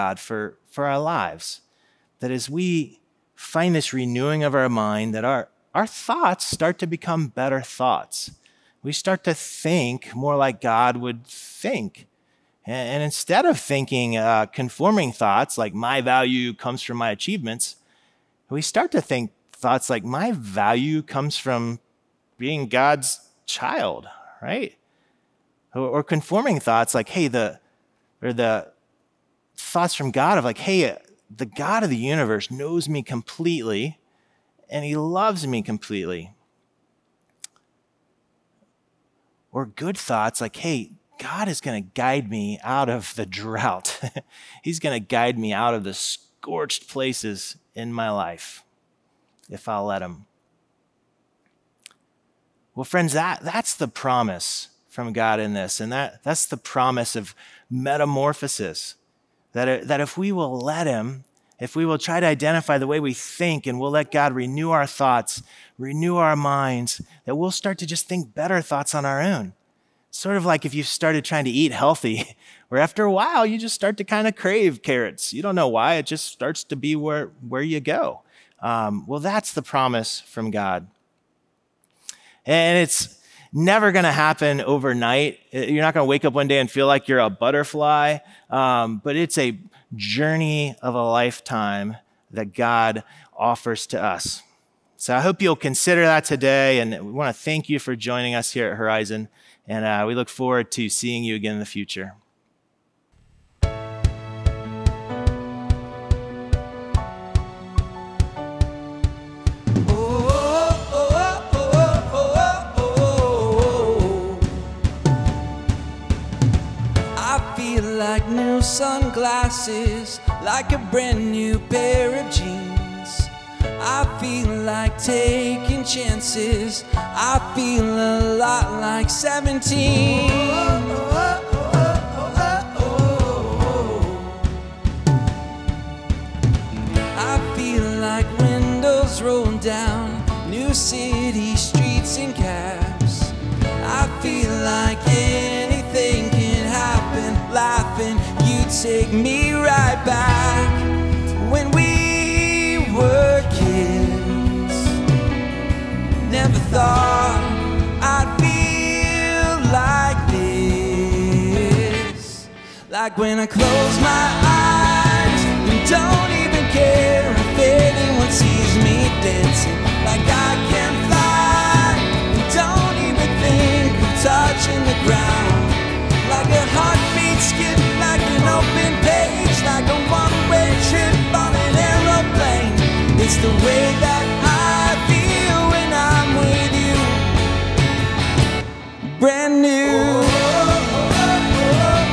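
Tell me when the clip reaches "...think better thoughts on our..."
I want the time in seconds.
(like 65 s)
68 s.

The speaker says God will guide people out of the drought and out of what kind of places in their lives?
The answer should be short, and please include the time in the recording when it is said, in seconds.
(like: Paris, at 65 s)
Scorched places, at 45 s.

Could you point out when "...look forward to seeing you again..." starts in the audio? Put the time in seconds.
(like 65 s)
100 s.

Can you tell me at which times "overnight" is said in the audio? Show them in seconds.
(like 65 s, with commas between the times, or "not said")
84 s.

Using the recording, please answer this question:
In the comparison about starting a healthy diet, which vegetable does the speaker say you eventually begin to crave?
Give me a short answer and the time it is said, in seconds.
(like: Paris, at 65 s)
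Carrots, at 74 s.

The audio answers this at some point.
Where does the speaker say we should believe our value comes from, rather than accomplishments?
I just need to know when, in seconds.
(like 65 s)
22 s.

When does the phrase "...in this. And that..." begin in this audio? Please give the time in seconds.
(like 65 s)
55 s.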